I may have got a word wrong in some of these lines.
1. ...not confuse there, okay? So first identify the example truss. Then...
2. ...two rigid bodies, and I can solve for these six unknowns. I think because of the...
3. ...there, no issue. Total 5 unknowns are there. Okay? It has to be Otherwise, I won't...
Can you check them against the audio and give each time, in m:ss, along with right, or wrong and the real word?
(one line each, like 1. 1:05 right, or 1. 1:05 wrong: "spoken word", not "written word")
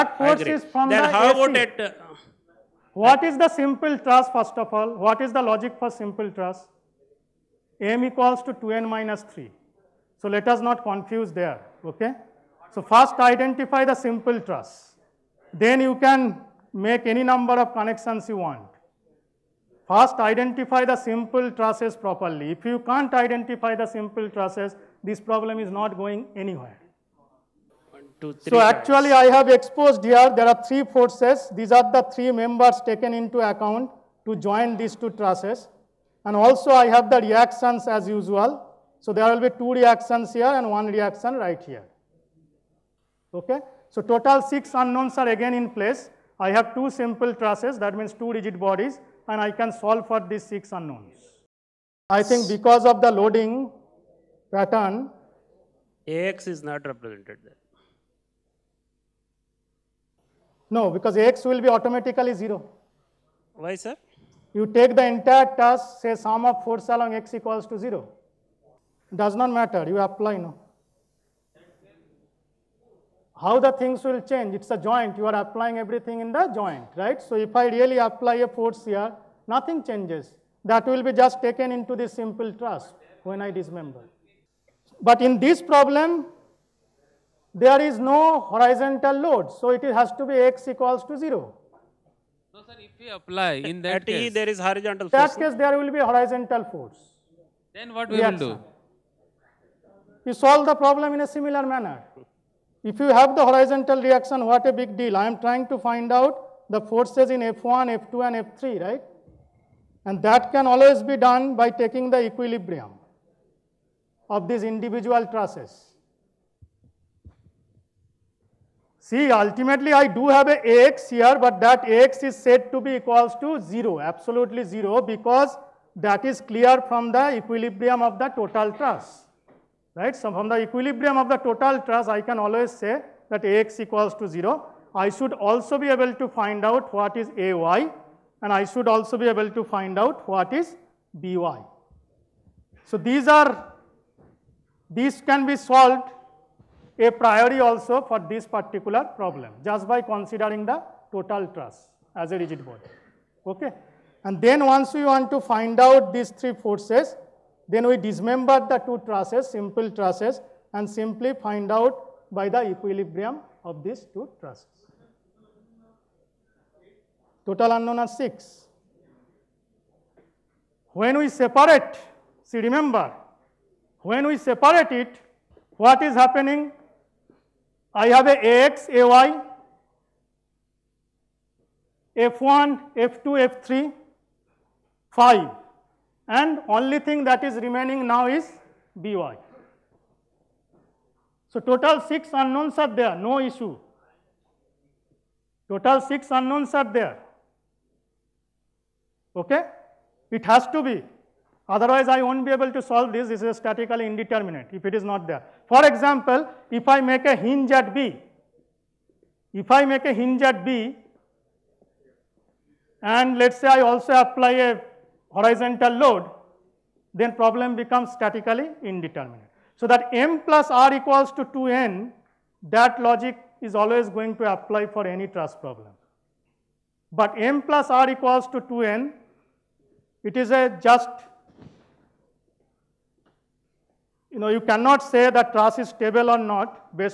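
1. 0:10 wrong: "simple", not "example"
2. 0:48 right
3. 3:12 wrong: "6", not "5".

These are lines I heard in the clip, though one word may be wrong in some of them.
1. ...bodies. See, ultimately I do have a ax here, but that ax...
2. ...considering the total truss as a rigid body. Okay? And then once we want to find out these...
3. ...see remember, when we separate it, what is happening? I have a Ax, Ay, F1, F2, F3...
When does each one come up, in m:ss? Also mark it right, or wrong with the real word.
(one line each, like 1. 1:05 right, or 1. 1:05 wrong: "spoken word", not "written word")
1. 1:55 wrong: "trusses", not "bodies"
2. 2:30 right
3. 2:52 right.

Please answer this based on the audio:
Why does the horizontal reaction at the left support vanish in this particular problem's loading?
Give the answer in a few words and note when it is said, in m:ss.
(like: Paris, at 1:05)
No horizontal load, at 1:27.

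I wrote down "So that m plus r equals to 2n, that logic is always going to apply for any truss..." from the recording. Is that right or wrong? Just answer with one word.
right.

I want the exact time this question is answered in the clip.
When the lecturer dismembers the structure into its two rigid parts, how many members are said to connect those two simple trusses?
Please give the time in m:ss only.
0:31.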